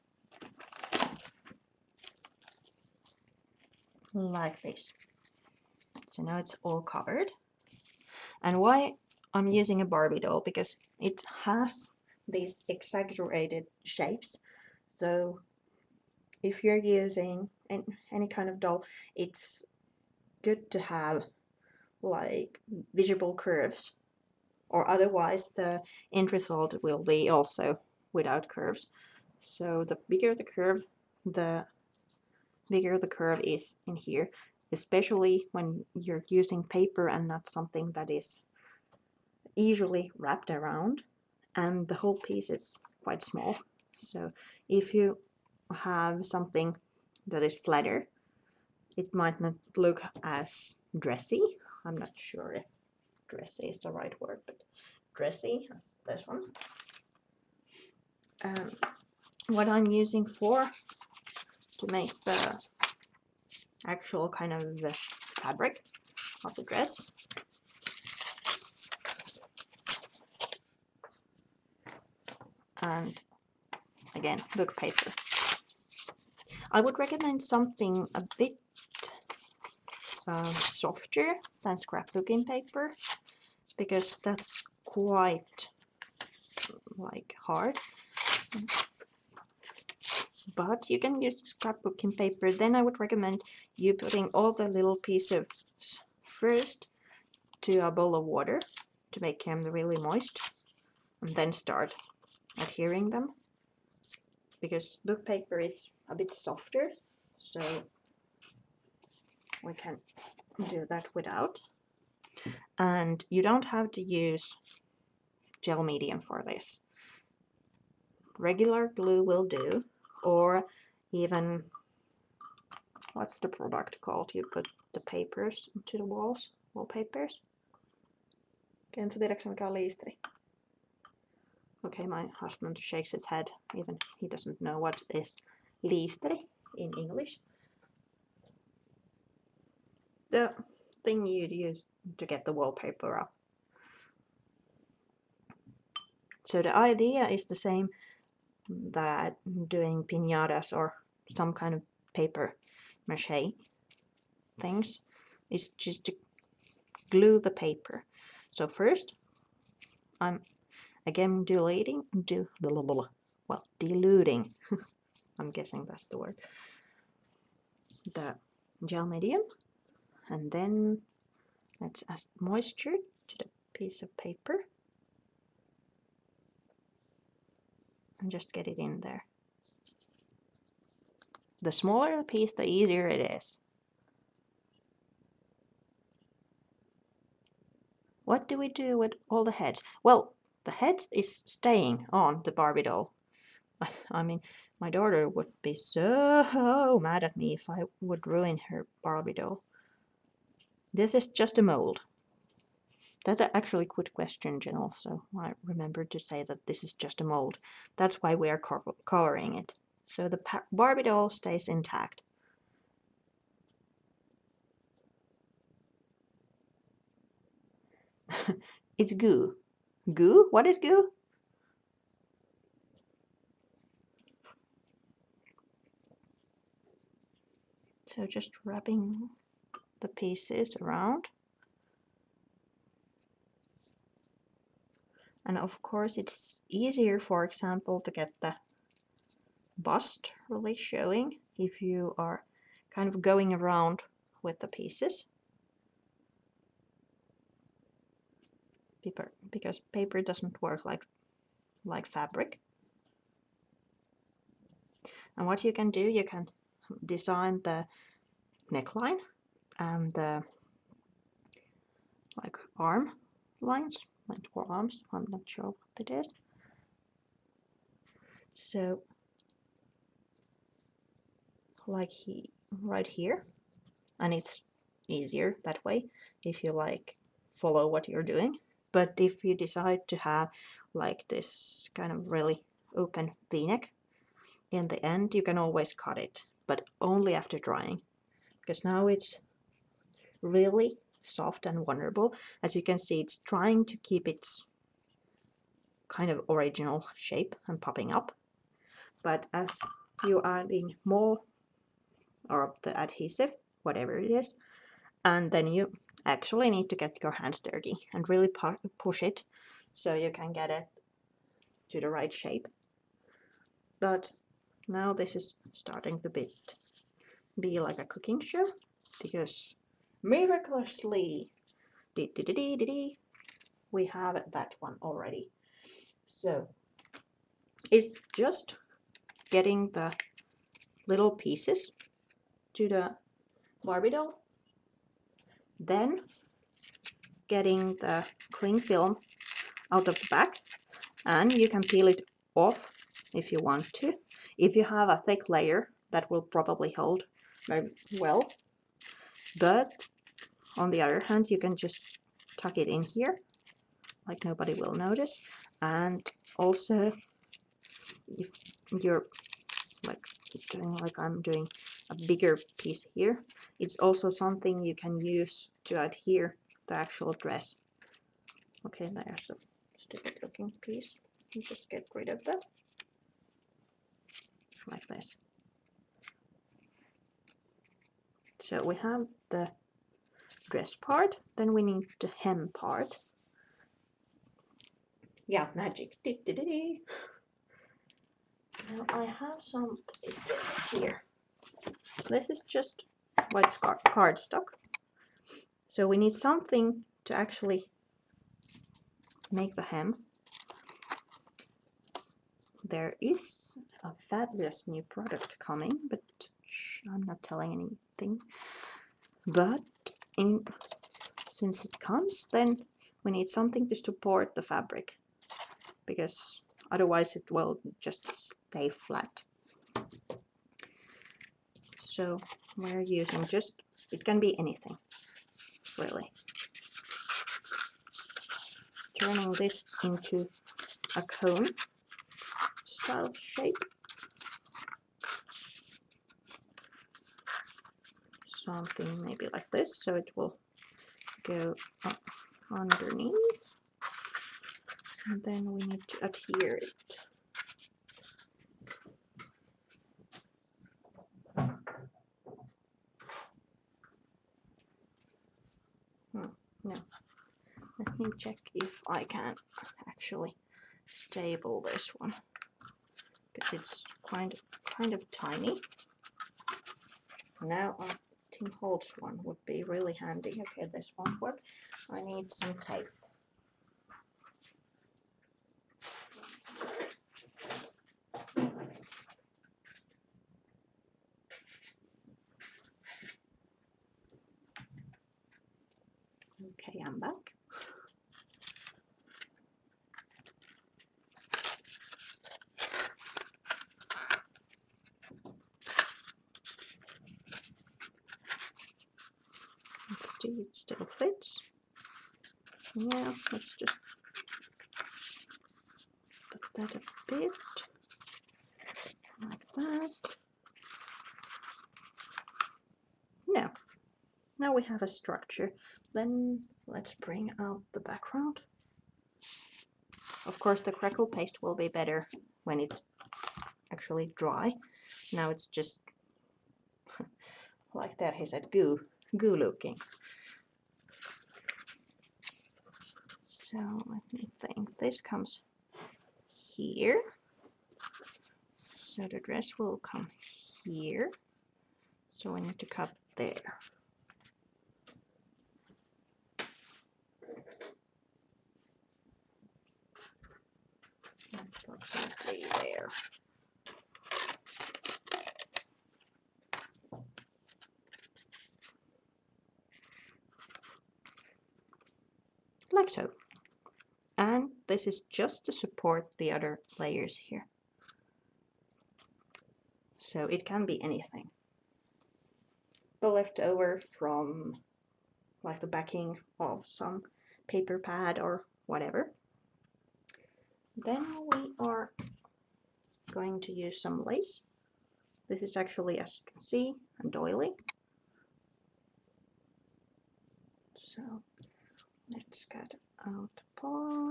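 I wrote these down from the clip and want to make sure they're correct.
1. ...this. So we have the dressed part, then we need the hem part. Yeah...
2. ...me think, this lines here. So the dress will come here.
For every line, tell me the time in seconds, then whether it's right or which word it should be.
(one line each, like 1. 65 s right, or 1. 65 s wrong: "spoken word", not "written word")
1. 375 s right
2. 534 s wrong: "comes", not "lines".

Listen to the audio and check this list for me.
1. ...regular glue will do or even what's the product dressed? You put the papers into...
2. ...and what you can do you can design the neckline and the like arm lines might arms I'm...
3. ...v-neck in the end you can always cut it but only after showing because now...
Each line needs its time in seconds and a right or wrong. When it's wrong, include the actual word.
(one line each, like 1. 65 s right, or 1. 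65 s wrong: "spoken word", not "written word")
1. 118 s wrong: "called", not "dressed"
2. 255 s right
3. 283 s wrong: "drying", not "showing".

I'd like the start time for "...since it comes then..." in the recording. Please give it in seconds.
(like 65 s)
411 s.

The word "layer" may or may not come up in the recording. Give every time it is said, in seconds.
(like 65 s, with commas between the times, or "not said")
345 s, 566 s.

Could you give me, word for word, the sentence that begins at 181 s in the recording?
The smaller the piece, the easier it is.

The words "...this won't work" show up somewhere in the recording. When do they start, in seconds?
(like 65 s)
470 s.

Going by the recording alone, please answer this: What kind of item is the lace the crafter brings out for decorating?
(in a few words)
A doily.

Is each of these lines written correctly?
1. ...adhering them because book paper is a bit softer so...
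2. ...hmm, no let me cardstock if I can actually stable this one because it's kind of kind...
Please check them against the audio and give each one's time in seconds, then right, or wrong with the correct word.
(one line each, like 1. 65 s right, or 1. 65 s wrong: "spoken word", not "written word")
1. 102 s right
2. 456 s wrong: "check", not "cardstock".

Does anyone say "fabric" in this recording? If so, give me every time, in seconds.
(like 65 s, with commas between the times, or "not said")
65 s, 252 s, 414 s.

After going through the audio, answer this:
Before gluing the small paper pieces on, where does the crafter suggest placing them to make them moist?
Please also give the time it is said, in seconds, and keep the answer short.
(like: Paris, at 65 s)
A bowl of water, at 97 s.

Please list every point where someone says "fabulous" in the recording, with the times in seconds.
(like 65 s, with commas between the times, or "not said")
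404 s.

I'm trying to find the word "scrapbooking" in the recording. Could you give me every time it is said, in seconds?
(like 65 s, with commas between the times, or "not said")
81 s, 91 s.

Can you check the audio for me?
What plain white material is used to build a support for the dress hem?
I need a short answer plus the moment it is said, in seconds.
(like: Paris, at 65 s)
White cardstock, at 393 s.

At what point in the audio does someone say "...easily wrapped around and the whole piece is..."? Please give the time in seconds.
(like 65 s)
39 s.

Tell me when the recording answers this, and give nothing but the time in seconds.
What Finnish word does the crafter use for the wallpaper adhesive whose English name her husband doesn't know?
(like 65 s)
135 s.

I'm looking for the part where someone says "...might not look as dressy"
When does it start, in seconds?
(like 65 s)
49 s.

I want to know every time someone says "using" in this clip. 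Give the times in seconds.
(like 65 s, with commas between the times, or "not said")
9 s, 16 s, 36 s, 59 s, 423 s.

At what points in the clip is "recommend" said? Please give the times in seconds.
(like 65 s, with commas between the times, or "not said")
76 s, 93 s.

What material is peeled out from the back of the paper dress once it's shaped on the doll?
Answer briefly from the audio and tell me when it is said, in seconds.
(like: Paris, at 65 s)
Cling film, at 338 s.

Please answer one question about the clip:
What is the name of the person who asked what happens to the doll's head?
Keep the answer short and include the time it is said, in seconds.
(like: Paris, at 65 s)
Jen, at 204 s.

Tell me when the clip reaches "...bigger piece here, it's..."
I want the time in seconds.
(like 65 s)
362 s.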